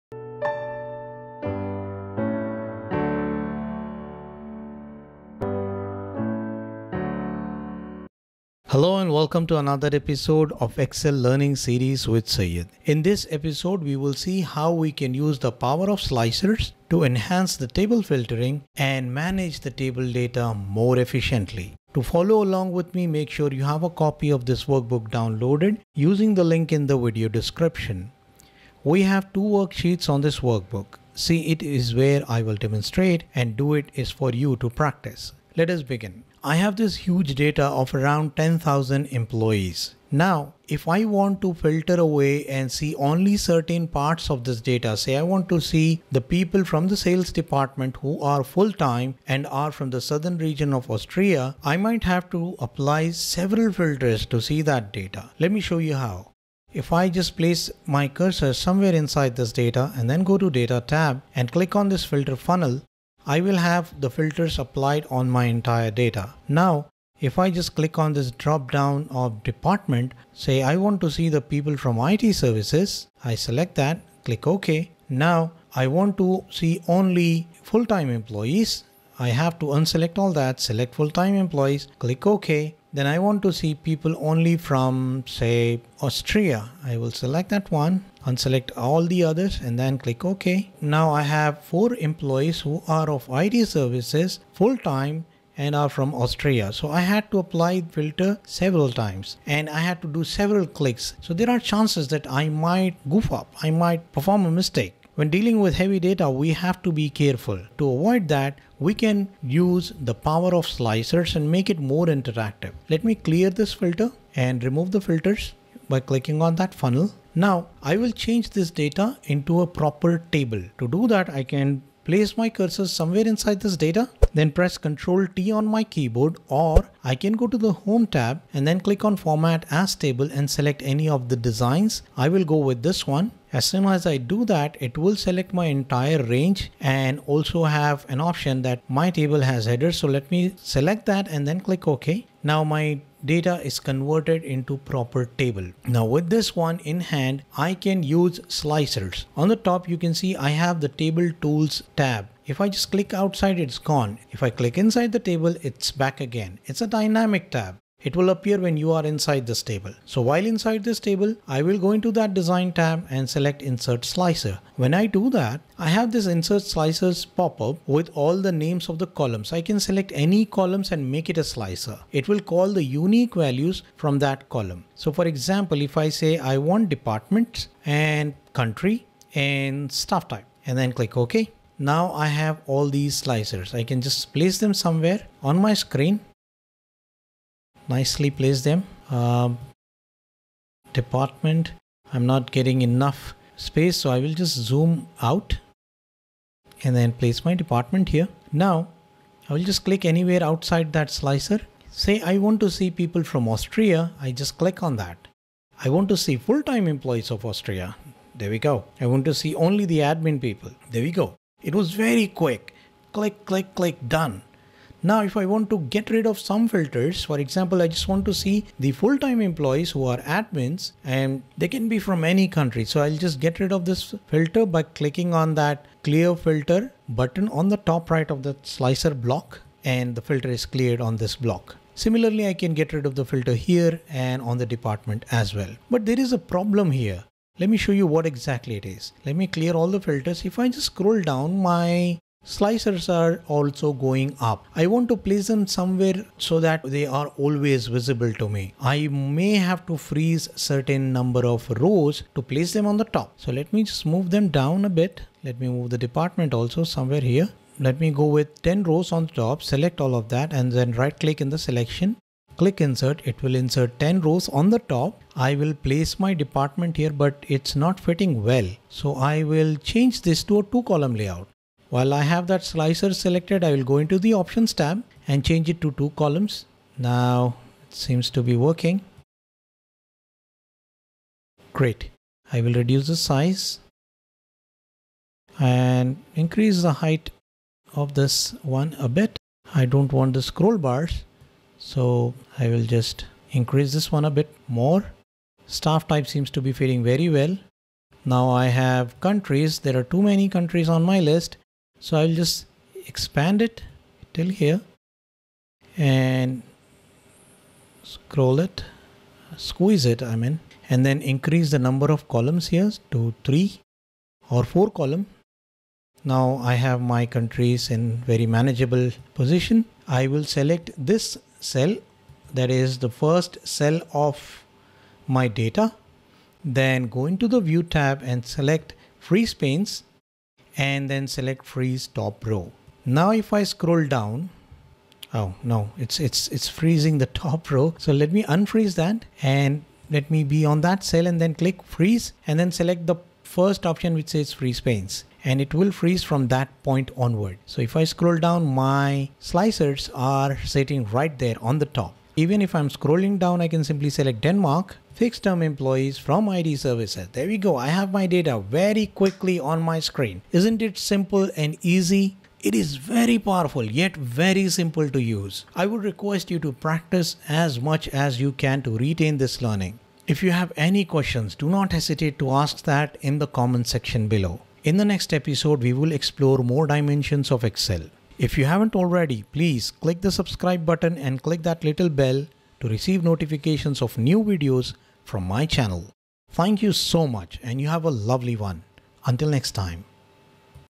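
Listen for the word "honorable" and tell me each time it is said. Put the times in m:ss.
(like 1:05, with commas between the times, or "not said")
not said.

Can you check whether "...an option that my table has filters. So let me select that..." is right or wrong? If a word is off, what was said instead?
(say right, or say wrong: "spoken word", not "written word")
wrong: "headers", not "filters".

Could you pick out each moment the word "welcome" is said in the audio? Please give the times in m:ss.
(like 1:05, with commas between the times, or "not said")
0:09.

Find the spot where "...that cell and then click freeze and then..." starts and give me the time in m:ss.
5:40.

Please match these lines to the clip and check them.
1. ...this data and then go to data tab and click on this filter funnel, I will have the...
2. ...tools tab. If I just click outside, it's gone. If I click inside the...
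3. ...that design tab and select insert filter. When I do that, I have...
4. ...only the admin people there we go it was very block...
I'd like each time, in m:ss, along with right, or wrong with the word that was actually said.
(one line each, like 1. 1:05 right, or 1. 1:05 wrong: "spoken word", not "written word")
1. 0:59 right
2. 2:31 right
3. 2:42 wrong: "slicer", not "filter"
4. 3:29 wrong: "quick", not "block".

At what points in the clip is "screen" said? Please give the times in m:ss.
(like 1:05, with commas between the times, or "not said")
3:05, 5:59.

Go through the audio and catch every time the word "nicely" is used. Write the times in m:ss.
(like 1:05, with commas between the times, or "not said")
3:07.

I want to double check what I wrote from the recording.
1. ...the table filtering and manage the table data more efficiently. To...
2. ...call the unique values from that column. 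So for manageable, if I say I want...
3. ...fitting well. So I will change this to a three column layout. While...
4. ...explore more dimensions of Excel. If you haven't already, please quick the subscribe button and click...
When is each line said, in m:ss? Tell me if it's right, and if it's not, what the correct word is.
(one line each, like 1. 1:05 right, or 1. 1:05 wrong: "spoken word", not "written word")
1. 0:17 right
2. 2:52 wrong: "example", not "manageable"
3. 4:27 wrong: "two", not "three"
4. 6:16 wrong: "click", not "quick".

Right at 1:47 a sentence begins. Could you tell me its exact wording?
To avoid that, we can use the power of slicers and make it more interactive.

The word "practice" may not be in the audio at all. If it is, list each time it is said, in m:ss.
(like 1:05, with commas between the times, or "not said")
0:34, 6:06.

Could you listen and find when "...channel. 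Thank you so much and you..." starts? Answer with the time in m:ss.
6:25.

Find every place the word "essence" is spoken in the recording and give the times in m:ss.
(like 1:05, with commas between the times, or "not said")
not said.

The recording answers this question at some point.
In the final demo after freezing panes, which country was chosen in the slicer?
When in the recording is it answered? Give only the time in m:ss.
5:54.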